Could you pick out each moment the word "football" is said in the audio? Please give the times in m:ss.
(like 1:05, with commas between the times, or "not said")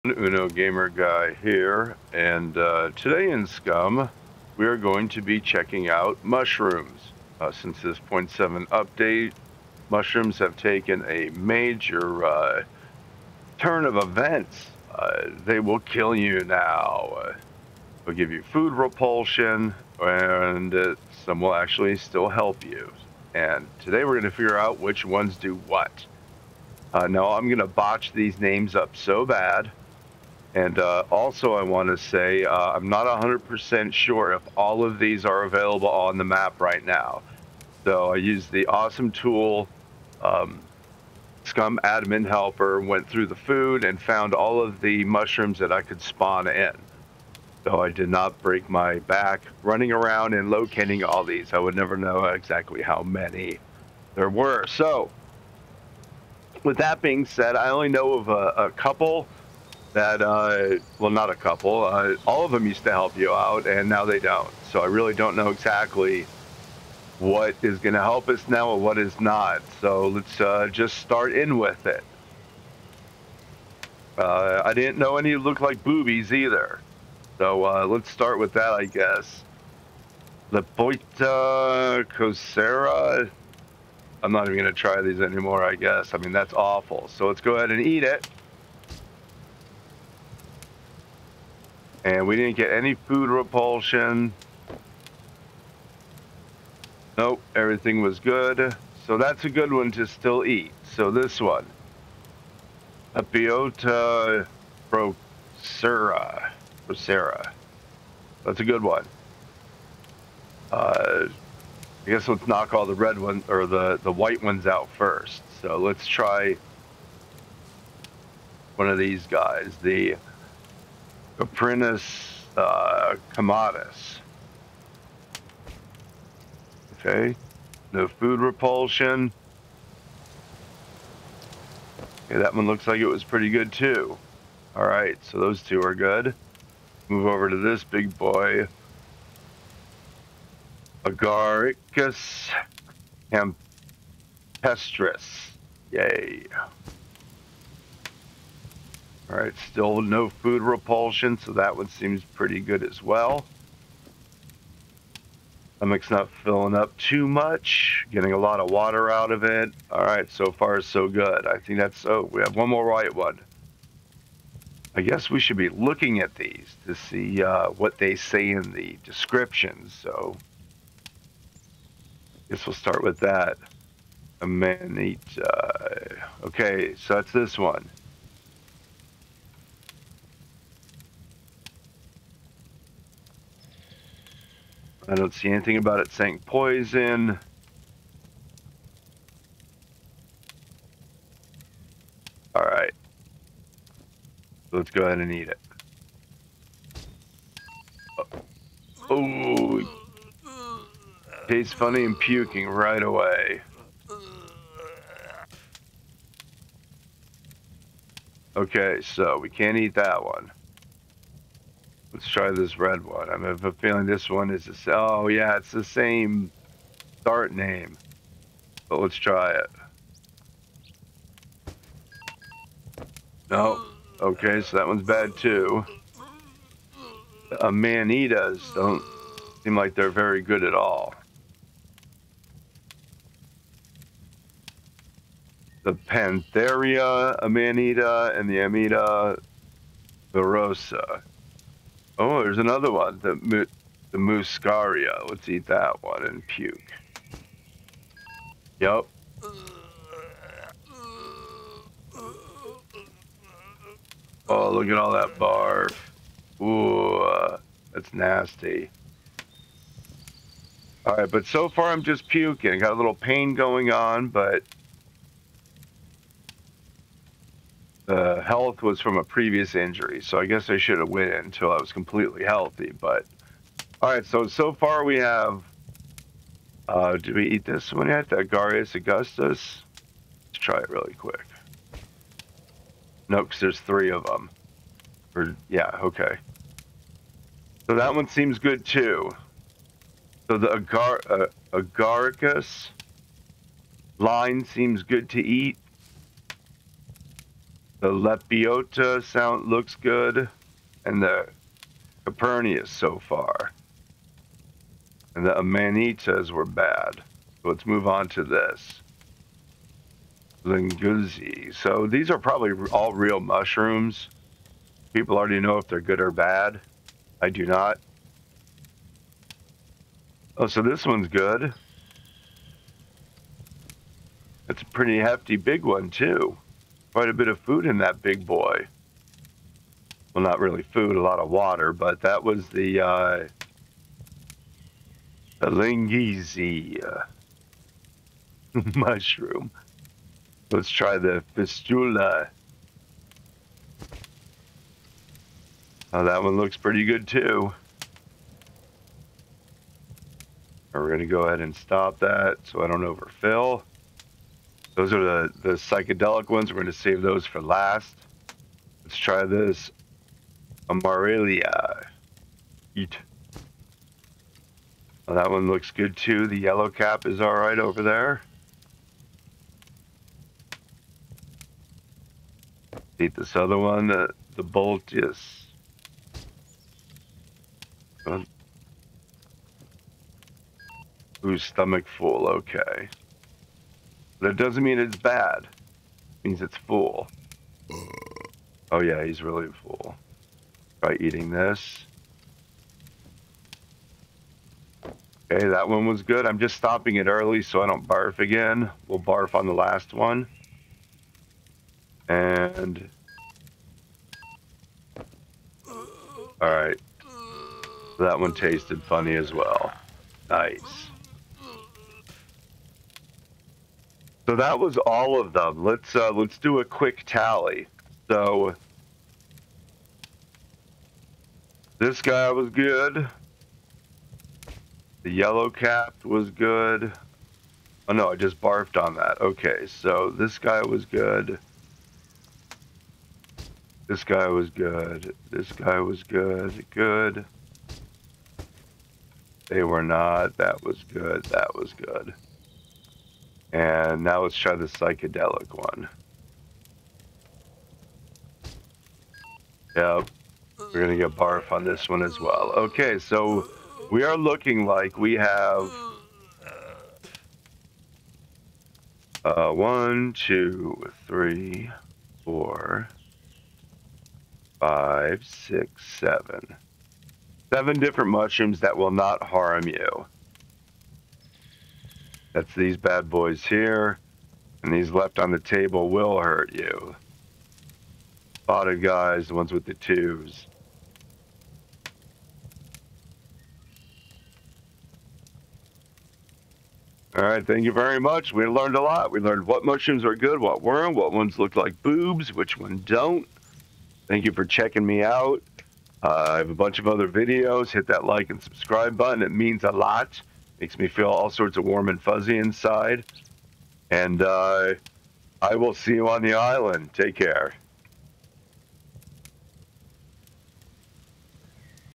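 not said.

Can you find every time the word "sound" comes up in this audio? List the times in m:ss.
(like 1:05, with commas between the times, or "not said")
4:59.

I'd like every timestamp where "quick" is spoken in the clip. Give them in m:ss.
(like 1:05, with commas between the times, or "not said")
4:41, 6:56.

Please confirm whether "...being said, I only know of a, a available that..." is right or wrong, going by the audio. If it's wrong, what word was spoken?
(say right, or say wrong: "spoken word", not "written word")
wrong: "couple", not "available".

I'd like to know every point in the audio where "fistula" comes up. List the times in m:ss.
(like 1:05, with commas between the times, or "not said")
5:41.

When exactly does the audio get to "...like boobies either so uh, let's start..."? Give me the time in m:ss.
1:15.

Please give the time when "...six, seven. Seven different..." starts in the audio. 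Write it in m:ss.
7:45.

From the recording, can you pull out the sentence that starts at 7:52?
That's these bad boys here, and these left on the table will hurt you.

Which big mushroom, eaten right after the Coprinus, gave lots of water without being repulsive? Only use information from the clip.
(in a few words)
Agaricus campestris.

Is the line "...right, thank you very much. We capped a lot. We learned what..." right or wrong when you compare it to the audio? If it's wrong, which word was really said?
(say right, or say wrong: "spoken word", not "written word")
wrong: "learned", not "capped".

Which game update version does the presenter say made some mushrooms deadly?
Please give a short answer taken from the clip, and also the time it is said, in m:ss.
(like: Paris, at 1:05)
0.7, at 0:08.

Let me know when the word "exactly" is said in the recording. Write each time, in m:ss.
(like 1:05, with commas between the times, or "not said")
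0:52, 1:05.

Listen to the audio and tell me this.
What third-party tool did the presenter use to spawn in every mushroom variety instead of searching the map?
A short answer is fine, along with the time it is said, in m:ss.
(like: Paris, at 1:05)
Scum Admin Helper, at 0:41.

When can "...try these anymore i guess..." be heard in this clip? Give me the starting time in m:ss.
1:24.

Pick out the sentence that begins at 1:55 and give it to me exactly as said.
So let's try one of these guys.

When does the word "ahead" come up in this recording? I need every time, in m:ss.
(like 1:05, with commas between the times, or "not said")
1:27, 3:15, 5:51.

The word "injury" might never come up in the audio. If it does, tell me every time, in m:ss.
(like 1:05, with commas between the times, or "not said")
4:29.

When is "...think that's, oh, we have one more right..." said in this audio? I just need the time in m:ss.
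2:41.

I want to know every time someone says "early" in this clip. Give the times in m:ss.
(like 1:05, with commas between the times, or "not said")
6:37.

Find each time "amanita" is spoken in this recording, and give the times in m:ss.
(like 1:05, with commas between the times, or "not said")
3:57, 5:05.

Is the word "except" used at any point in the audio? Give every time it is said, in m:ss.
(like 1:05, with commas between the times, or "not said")
not said.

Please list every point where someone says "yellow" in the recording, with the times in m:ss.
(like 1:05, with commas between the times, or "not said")
6:06, 7:05.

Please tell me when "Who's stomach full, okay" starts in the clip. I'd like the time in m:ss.
6:21.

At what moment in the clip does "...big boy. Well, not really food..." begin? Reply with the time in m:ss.
5:28.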